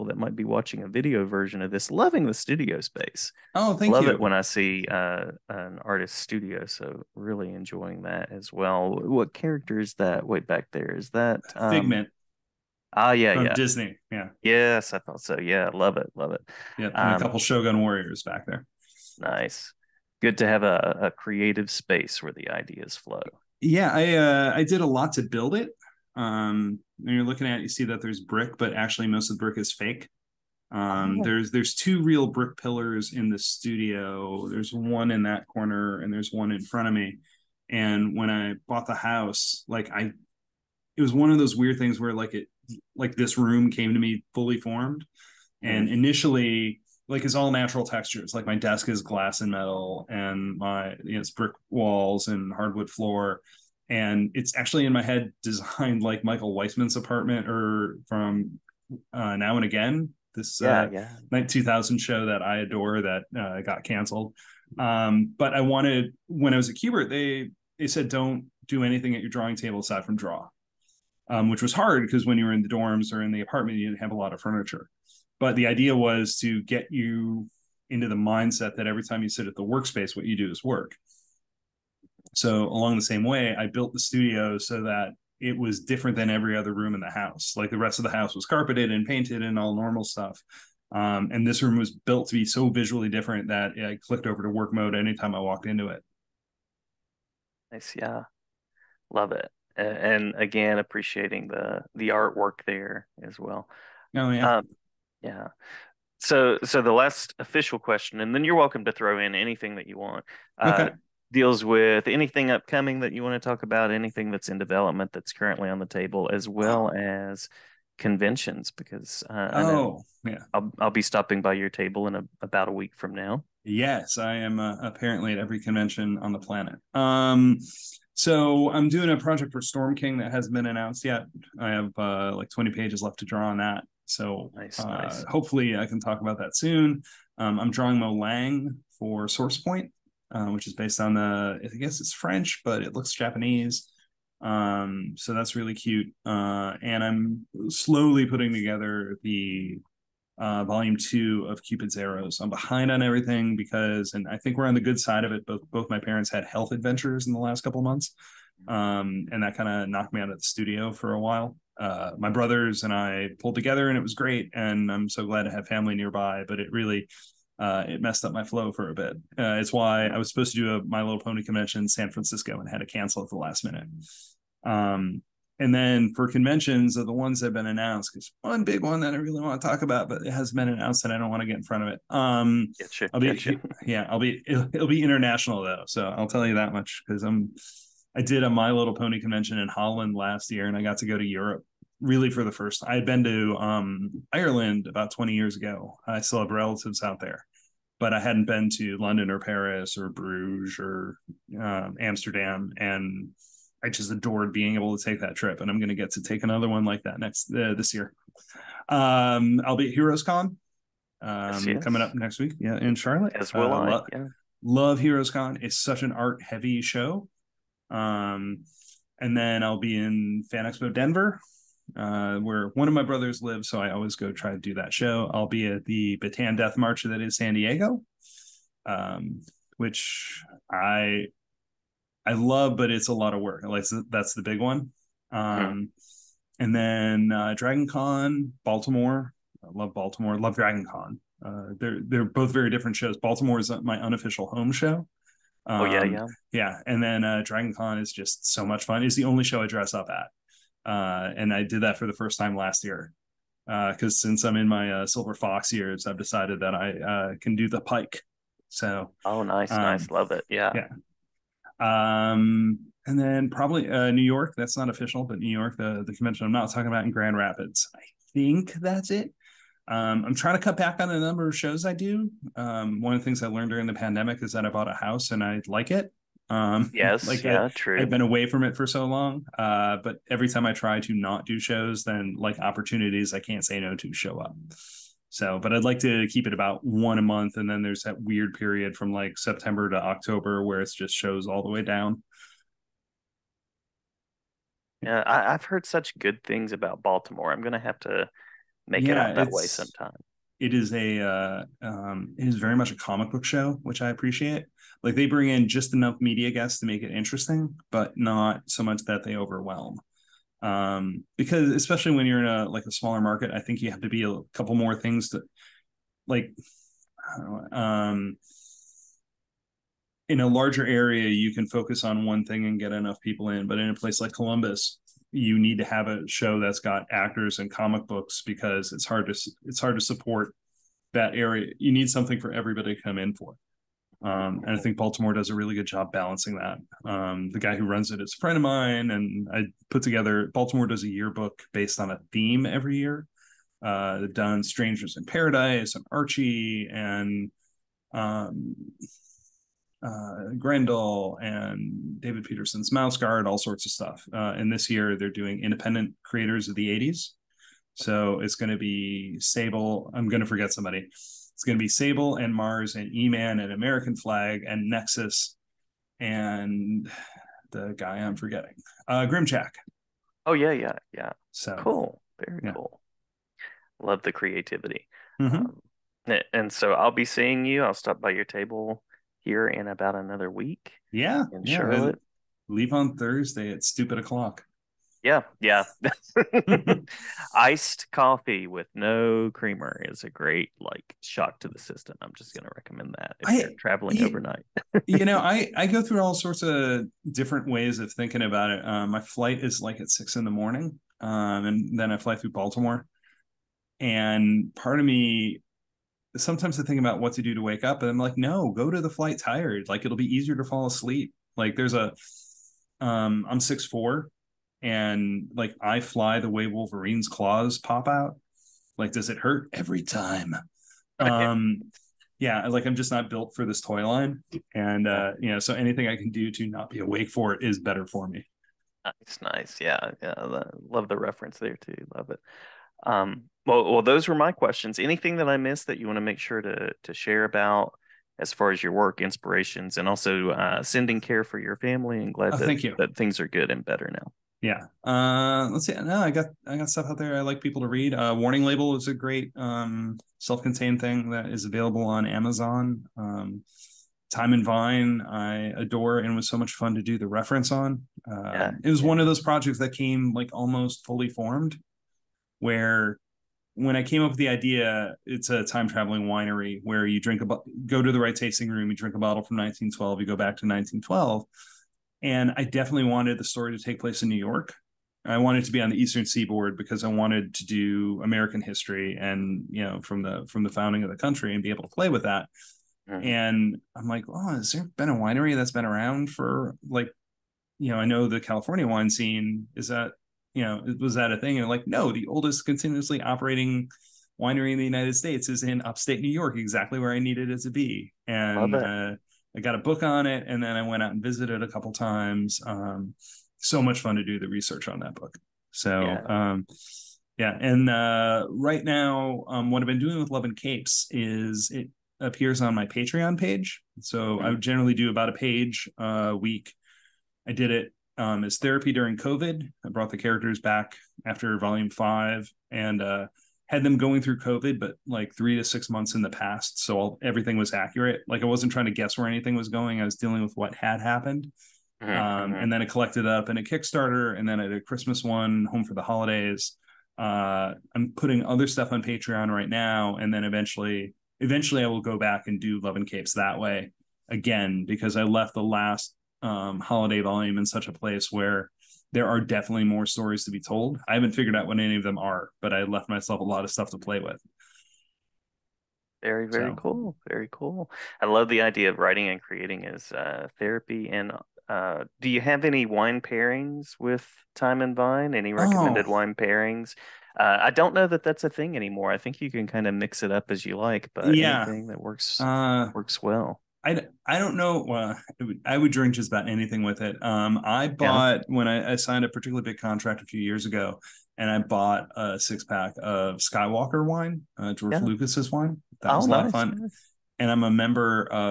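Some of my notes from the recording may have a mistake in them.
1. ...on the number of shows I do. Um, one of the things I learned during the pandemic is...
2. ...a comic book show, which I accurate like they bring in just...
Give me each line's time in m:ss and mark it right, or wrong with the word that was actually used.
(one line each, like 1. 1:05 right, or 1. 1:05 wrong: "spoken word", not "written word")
1. 4:30 right
2. 5:02 wrong: "appreciate", not "accurate".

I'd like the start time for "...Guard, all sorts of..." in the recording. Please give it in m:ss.
5:53.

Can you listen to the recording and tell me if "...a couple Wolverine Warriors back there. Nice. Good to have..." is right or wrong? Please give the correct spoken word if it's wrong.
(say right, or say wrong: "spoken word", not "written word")
wrong: "Shogun", not "Wolverine".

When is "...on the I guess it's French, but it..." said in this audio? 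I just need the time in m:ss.
2:21.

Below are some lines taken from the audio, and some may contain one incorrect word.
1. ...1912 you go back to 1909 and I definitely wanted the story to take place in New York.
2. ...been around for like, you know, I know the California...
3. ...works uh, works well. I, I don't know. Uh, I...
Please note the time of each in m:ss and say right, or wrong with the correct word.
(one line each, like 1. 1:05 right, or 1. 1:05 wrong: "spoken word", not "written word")
1. 7:49 wrong: "1912", not "1909"
2. 8:05 right
3. 9:32 right.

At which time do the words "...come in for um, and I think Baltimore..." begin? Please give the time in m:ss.
5:33.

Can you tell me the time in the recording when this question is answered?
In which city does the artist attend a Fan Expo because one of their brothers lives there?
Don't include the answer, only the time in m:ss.
3:40.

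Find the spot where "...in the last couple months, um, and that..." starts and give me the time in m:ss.
2:37.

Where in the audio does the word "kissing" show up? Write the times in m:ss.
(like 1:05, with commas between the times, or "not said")
not said.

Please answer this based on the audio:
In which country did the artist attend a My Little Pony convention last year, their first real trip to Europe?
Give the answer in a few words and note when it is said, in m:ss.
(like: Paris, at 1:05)
Holland, at 3:09.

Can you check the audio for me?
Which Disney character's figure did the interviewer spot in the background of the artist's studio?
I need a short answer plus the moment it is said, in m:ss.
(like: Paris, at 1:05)
Figment, at 0:11.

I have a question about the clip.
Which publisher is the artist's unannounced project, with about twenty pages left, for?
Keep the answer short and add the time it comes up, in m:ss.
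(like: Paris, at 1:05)
Storm King, at 2:09.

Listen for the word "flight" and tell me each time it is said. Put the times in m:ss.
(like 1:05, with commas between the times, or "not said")
6:39, 6:49.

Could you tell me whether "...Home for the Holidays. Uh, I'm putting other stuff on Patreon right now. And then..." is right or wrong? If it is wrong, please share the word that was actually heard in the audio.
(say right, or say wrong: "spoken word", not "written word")
right.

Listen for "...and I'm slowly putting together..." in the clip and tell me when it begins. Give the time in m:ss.
2:26.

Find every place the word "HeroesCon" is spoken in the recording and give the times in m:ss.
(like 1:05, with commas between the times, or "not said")
3:29, 3:35.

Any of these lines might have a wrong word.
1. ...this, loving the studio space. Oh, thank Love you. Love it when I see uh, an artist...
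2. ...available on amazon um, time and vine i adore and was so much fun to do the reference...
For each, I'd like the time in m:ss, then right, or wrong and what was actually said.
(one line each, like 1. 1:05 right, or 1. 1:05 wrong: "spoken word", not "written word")
1. 0:01 right
2. 7:31 right.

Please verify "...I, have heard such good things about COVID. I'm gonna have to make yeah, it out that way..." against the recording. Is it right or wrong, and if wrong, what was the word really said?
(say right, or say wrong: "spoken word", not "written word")
wrong: "Baltimore", not "COVID".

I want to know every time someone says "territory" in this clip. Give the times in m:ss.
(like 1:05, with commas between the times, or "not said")
not said.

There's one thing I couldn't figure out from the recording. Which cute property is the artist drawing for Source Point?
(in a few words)
Molang.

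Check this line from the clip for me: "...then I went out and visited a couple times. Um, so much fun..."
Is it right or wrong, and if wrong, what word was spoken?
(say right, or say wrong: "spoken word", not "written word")
right.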